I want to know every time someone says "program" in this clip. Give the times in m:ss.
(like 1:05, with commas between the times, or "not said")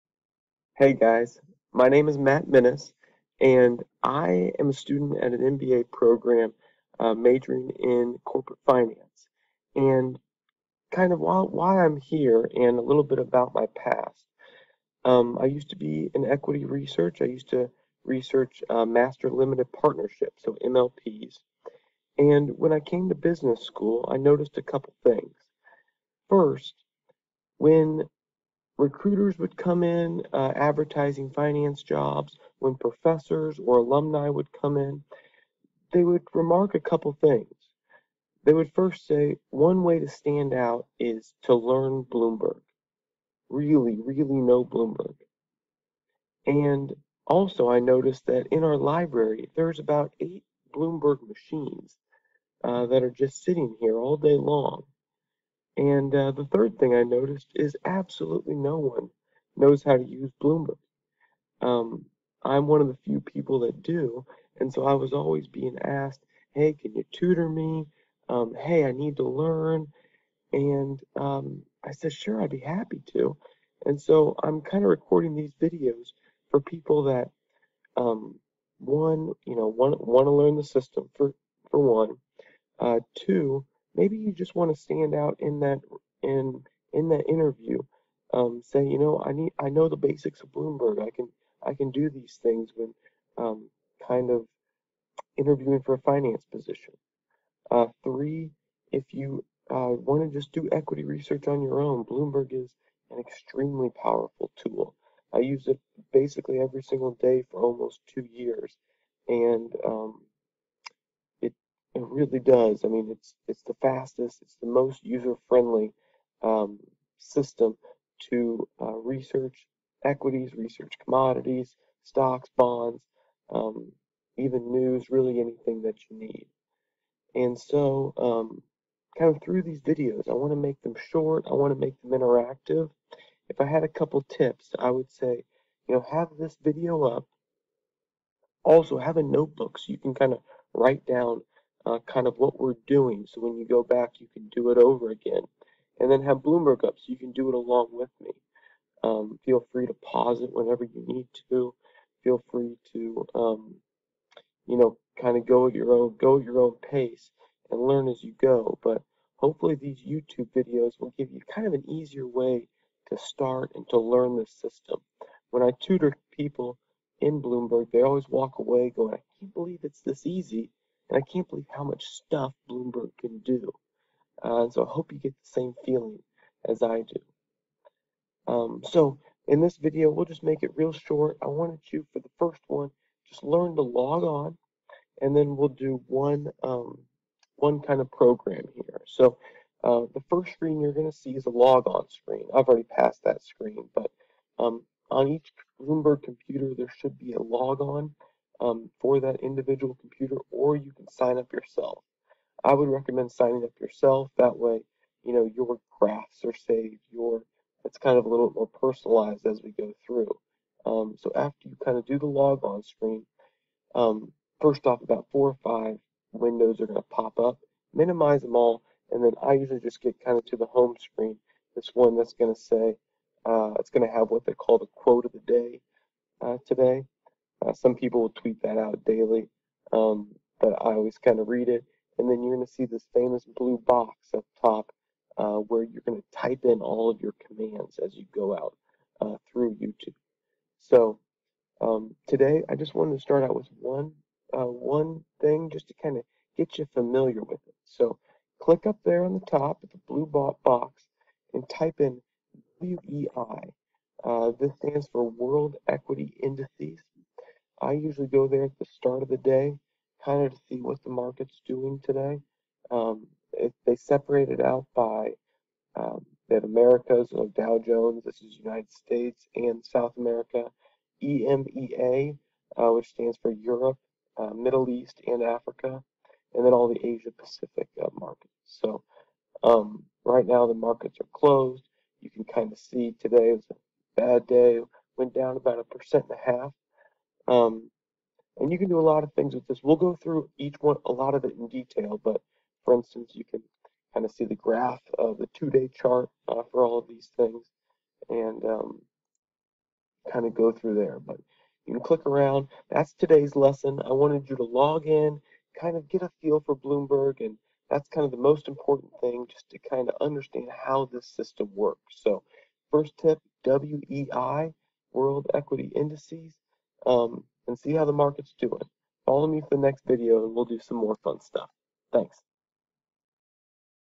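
0:05, 3:08.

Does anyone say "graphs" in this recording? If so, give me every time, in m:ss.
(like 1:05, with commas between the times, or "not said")
3:25, 4:54.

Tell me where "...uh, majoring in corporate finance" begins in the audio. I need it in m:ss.
0:06.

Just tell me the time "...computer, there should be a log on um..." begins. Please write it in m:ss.
3:16.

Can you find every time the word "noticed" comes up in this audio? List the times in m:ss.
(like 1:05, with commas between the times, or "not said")
0:24, 0:47, 0:57.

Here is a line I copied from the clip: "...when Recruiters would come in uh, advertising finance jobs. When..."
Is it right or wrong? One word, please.
right.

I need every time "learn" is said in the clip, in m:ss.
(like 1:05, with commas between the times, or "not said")
0:41, 1:09, 1:20, 2:37, 2:43, 3:03.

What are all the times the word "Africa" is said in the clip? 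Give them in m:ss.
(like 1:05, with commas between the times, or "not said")
4:35.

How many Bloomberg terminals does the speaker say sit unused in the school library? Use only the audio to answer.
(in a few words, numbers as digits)
8.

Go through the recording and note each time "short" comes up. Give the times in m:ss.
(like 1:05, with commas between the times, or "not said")
2:11, 3:00.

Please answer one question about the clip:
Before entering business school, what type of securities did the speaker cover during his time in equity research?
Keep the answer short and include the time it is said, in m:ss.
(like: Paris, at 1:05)
Master limited partnerships, at 0:18.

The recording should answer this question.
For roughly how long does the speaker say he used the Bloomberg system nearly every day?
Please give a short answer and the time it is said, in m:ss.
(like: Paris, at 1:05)
2 years, at 1:48.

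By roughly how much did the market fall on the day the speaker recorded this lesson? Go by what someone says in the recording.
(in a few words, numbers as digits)
1.5 percent.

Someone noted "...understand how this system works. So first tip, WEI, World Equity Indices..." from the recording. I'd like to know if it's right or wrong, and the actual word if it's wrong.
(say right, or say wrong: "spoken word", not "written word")
right.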